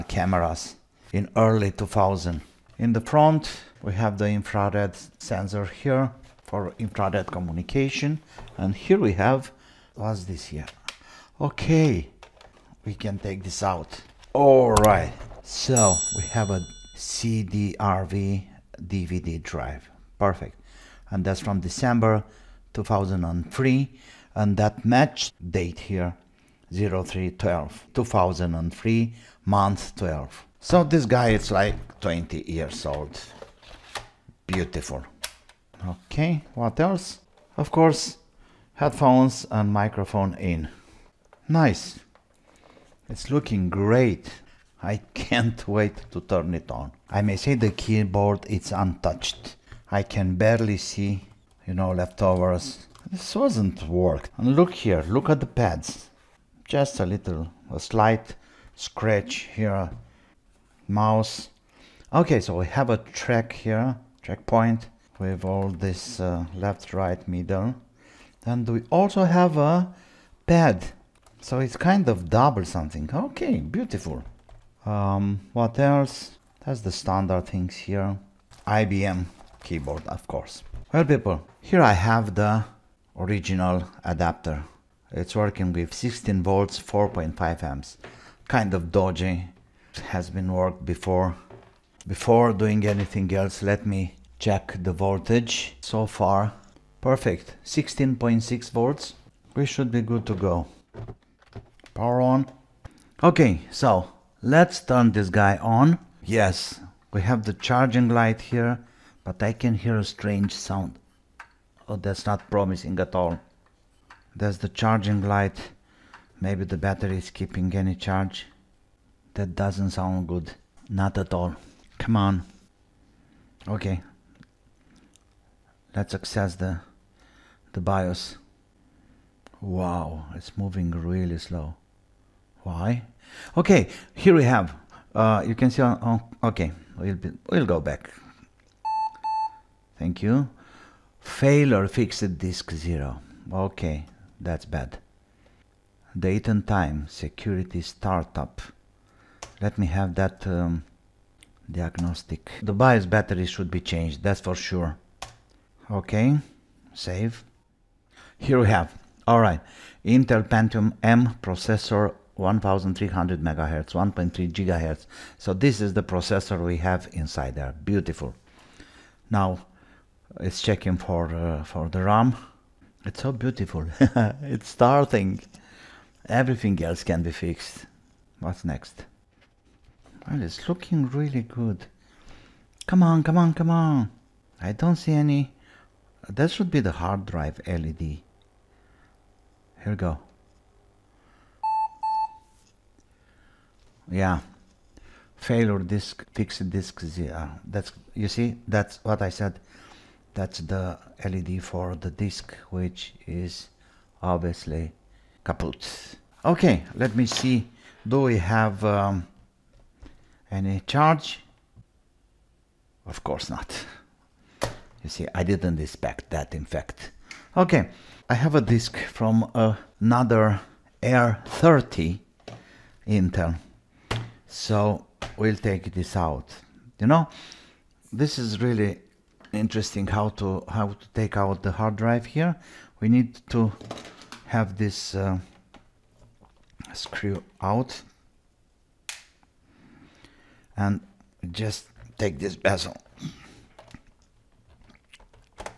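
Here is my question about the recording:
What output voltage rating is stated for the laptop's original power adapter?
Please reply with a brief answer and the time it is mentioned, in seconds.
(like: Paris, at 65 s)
16 volts, at 85 s.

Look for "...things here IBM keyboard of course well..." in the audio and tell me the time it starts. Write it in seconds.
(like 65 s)
77 s.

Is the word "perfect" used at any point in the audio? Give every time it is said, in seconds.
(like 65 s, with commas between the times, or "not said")
20 s, 97 s.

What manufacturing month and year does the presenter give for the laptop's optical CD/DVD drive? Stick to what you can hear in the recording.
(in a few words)
December 2003.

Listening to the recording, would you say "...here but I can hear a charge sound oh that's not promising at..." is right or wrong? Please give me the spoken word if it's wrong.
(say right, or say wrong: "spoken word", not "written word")
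wrong: "strange", not "charge".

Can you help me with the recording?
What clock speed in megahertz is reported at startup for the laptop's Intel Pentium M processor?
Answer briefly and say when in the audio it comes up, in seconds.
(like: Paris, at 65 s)
1300 megahertz, at 162 s.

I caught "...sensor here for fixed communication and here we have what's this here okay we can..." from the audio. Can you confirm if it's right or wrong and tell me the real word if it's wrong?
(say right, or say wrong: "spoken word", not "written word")
wrong: "infrared", not "fixed".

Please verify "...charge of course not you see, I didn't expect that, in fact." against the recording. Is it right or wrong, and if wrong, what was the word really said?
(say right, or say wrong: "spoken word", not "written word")
right.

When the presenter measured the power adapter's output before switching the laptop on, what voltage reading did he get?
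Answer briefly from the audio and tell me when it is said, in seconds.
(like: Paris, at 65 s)
16.6 volts, at 97 s.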